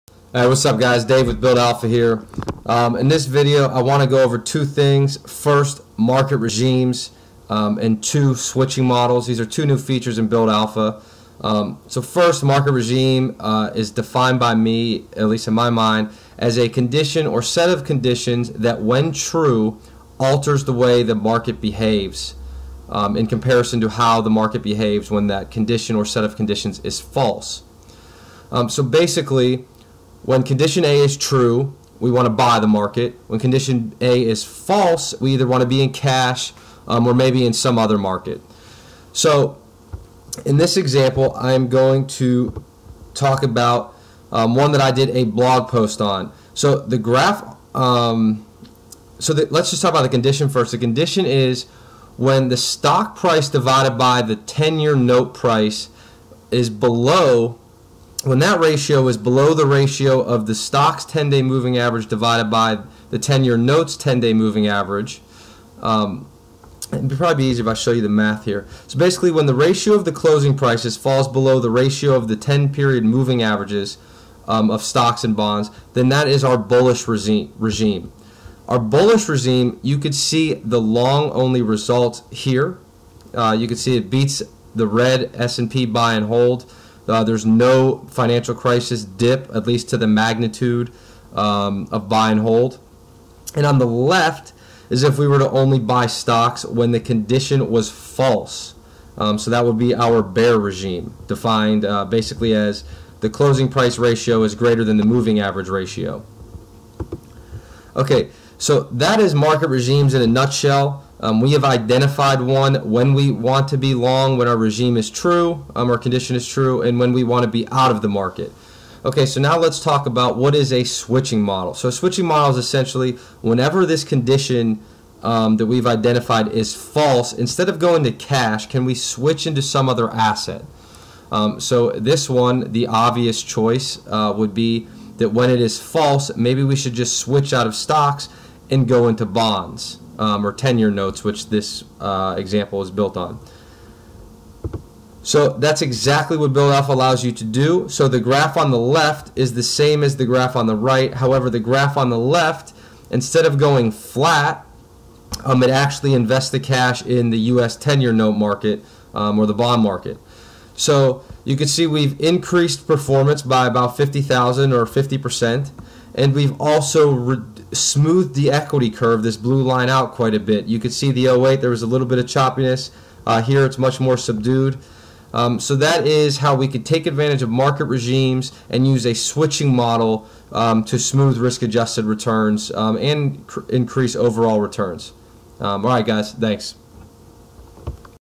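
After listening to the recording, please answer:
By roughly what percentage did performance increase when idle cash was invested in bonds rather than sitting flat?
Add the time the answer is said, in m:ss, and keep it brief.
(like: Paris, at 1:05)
50 percent, at 2:44.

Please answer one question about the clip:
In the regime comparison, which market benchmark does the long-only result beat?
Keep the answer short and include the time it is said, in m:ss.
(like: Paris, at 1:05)
S&P buy and hold, at 1:25.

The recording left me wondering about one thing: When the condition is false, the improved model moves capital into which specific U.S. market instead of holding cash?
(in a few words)
U.S. 10-year note.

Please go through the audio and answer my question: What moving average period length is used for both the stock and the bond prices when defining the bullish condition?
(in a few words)
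10.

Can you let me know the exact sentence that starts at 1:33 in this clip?
And on the left is if we were to only buy stocks when the condition was false.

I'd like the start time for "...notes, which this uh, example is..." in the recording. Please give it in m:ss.
2:20.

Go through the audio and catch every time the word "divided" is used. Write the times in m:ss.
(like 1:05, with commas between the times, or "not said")
0:53, 1:02.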